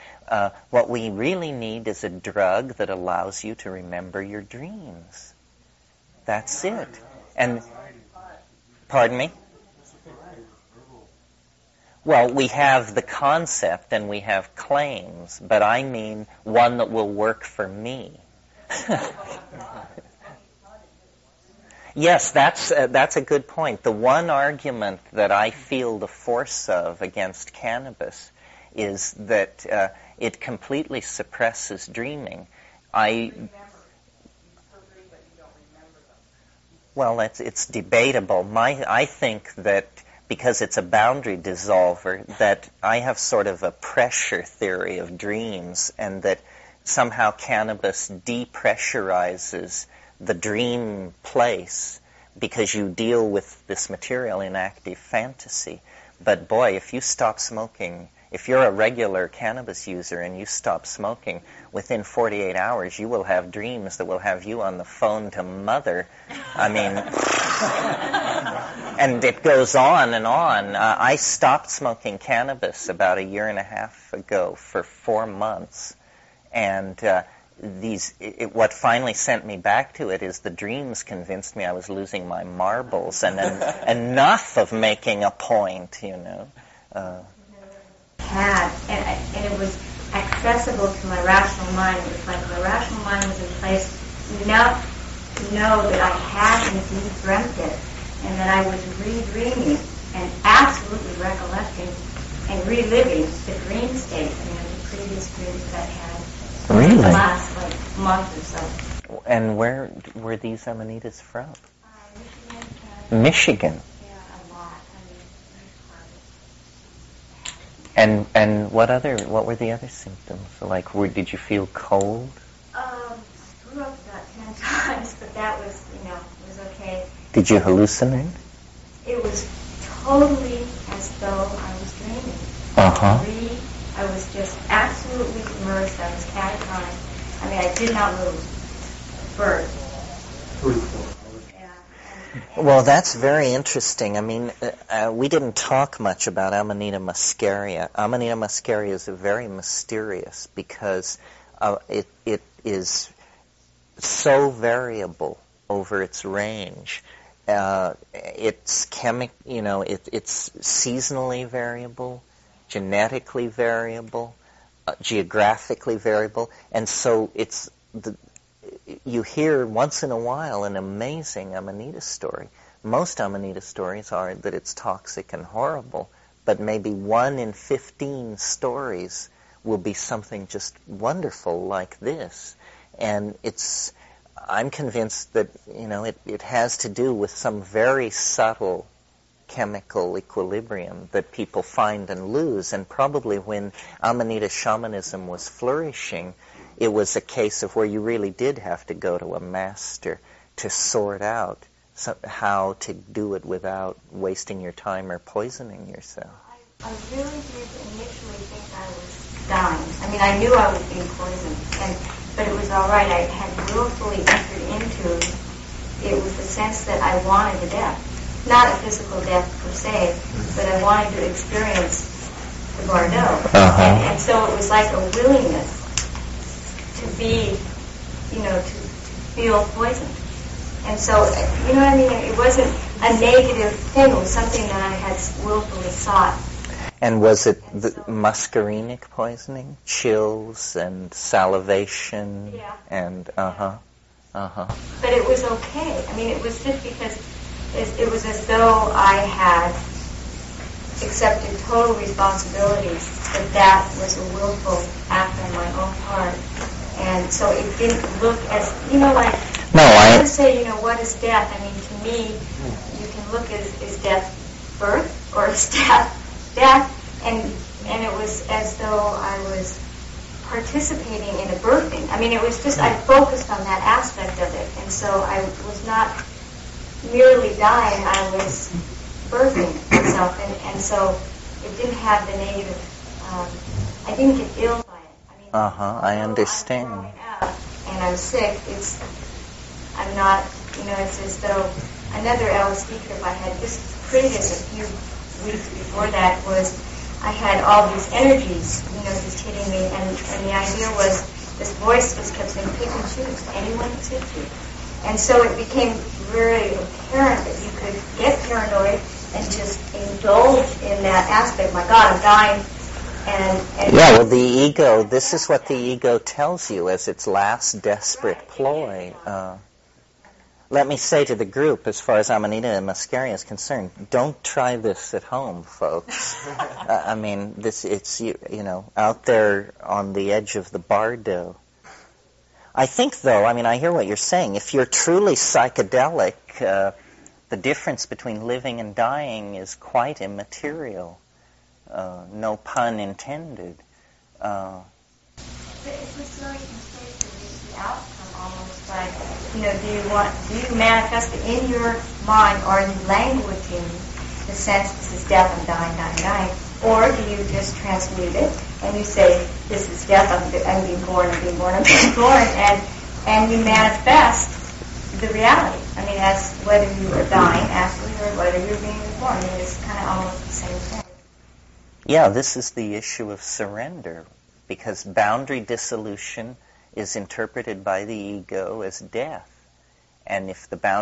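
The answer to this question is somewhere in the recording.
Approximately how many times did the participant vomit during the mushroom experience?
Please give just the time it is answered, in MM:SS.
02:04.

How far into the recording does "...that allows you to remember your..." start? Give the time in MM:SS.
00:02.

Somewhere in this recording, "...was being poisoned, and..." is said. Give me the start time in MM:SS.
03:30.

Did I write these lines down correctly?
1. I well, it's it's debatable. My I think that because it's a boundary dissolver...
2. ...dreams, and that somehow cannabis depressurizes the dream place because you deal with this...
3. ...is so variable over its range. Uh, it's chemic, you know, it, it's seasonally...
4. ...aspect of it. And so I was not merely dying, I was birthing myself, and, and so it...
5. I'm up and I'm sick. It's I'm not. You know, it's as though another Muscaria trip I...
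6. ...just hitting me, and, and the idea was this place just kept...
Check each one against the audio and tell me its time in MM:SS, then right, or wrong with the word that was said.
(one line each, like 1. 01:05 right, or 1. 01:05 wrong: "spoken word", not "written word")
1. 00:32 right
2. 00:45 right
3. 02:32 right
4. 04:33 right
5. 04:46 wrong: "LSD", not "Muscaria"
6. 04:59 wrong: "voice", not "place".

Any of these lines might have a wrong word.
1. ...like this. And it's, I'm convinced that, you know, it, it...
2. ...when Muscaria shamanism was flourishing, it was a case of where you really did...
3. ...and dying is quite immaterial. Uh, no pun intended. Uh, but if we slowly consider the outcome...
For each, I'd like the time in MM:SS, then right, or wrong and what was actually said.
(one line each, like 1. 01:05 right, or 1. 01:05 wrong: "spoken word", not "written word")
1. 03:01 right
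2. 03:13 wrong: "Amanita", not "Muscaria"
3. 05:38 right.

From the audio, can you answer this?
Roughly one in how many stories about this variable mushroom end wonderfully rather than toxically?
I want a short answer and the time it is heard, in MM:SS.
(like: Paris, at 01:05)
15, at 02:57.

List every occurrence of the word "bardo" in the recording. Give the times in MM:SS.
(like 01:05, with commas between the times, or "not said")
03:42, 05:30.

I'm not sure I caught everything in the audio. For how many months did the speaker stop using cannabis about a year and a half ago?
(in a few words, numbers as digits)
4.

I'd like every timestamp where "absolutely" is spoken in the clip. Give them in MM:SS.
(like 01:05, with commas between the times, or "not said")
01:40, 02:14.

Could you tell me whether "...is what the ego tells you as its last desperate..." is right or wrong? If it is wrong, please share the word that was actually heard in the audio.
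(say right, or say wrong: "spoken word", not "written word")
right.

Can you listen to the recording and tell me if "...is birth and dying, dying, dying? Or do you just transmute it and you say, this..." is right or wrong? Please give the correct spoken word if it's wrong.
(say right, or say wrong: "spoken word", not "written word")
wrong: "death", not "birth".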